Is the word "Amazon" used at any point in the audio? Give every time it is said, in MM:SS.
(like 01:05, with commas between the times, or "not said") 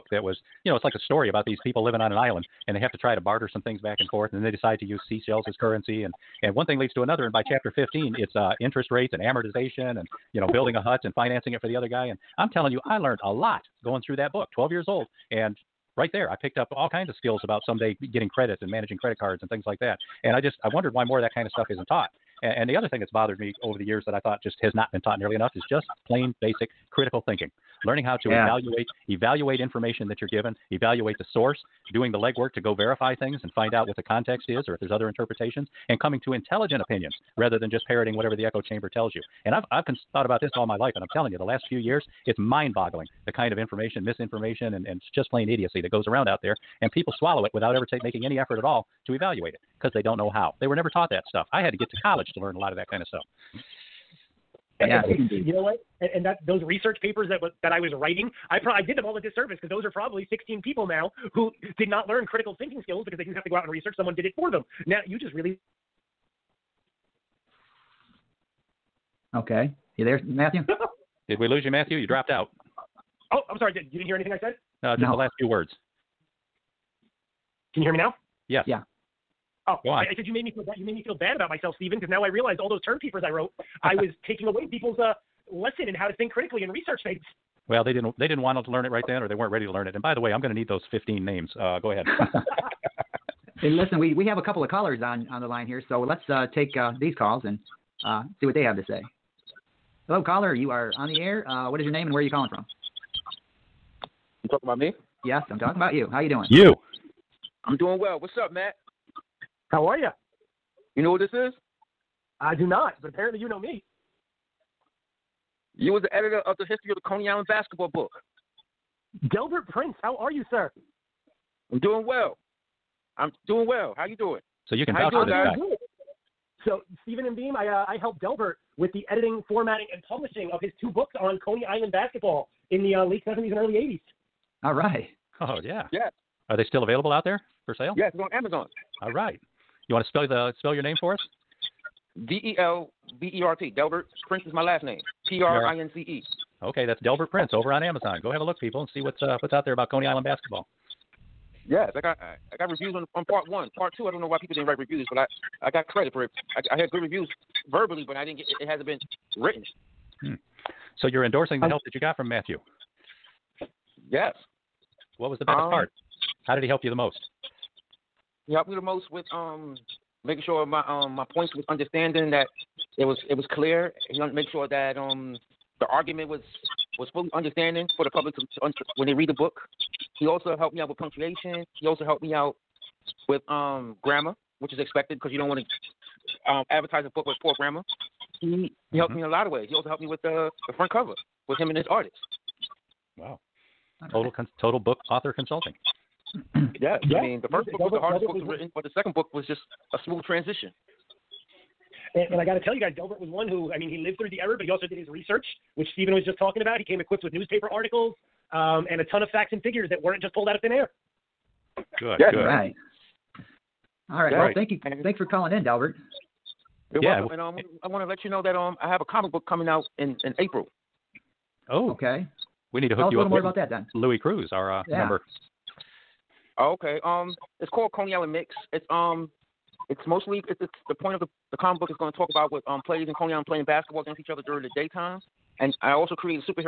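02:18, 02:27.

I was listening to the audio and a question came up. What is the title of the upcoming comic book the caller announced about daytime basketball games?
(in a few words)
Coney Island Mix.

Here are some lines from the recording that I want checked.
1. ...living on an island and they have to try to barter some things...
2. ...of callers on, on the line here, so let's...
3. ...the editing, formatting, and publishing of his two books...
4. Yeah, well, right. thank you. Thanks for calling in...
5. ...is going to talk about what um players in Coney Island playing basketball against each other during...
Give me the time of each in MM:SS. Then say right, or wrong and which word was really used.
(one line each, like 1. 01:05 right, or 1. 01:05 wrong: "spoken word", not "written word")
1. 00:01 right
2. 01:34 right
3. 02:08 right
4. 03:34 right
5. 03:51 right.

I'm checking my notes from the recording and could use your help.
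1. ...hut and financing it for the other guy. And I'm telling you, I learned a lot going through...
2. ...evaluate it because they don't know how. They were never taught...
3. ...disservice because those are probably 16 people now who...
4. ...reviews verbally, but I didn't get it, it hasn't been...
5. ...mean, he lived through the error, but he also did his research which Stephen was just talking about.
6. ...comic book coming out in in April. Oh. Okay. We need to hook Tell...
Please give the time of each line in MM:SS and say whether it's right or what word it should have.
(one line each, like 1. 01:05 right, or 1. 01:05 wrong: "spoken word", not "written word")
1. 00:10 right
2. 00:49 right
3. 00:59 right
4. 02:37 right
5. 03:23 right
6. 03:39 right.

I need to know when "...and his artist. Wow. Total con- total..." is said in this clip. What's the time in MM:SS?
03:11.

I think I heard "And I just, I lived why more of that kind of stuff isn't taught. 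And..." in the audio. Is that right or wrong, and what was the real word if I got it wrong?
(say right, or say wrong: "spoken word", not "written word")
wrong: "wondered", not "lived".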